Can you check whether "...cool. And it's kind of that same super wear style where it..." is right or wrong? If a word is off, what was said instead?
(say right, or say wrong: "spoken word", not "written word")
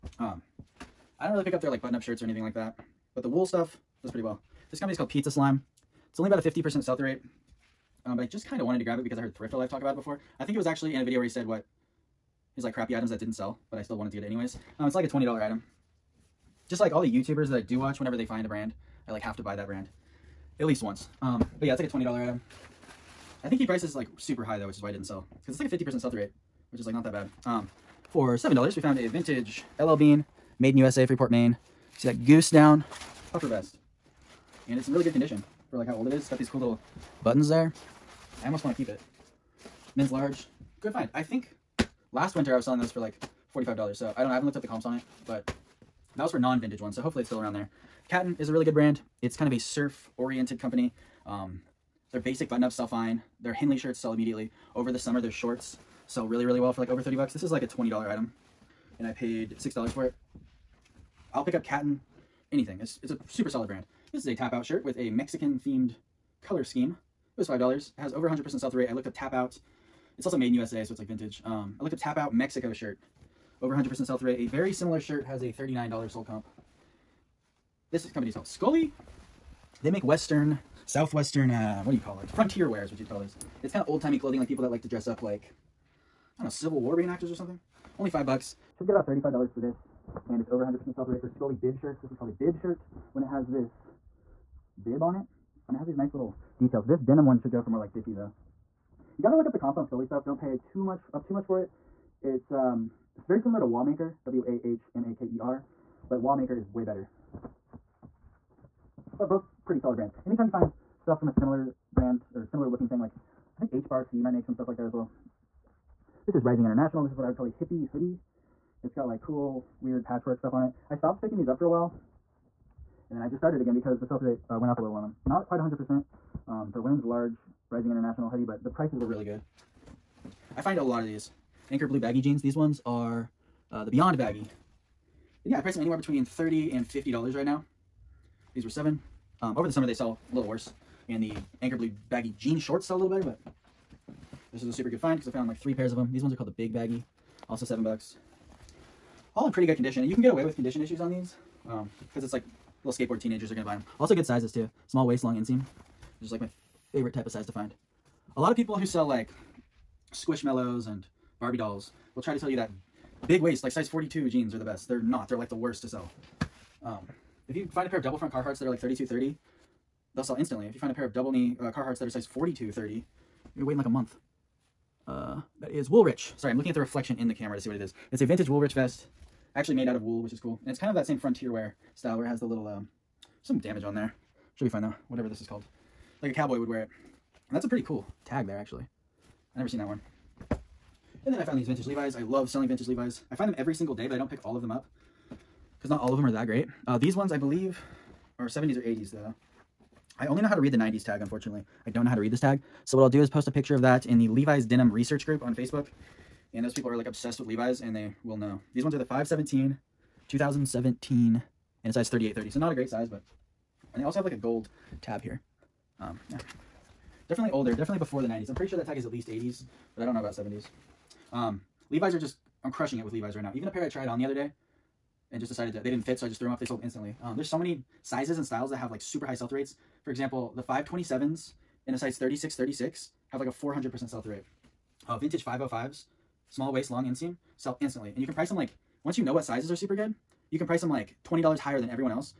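wrong: "frontier", not "super".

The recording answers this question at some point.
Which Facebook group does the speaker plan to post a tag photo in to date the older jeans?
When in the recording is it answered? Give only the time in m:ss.
3:24.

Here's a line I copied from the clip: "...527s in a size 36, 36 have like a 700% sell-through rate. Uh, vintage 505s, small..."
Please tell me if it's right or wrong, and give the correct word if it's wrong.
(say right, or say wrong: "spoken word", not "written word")
wrong: "400", not "700".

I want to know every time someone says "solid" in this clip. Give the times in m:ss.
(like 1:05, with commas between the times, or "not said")
1:03, 1:49.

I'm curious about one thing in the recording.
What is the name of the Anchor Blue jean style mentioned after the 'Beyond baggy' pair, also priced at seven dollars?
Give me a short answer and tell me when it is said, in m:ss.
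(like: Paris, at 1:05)
Big Baggy, at 2:26.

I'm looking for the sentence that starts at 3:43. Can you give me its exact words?
Even a pair I tried on the other day and just decided that they didn't fit, so I just threw them up.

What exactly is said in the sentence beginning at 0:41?
I think last winter I was selling those for like $45.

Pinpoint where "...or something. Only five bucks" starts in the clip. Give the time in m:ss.
1:27.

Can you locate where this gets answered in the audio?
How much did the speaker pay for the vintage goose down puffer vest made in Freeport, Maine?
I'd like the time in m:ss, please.
0:28.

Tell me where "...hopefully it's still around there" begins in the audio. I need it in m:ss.
0:47.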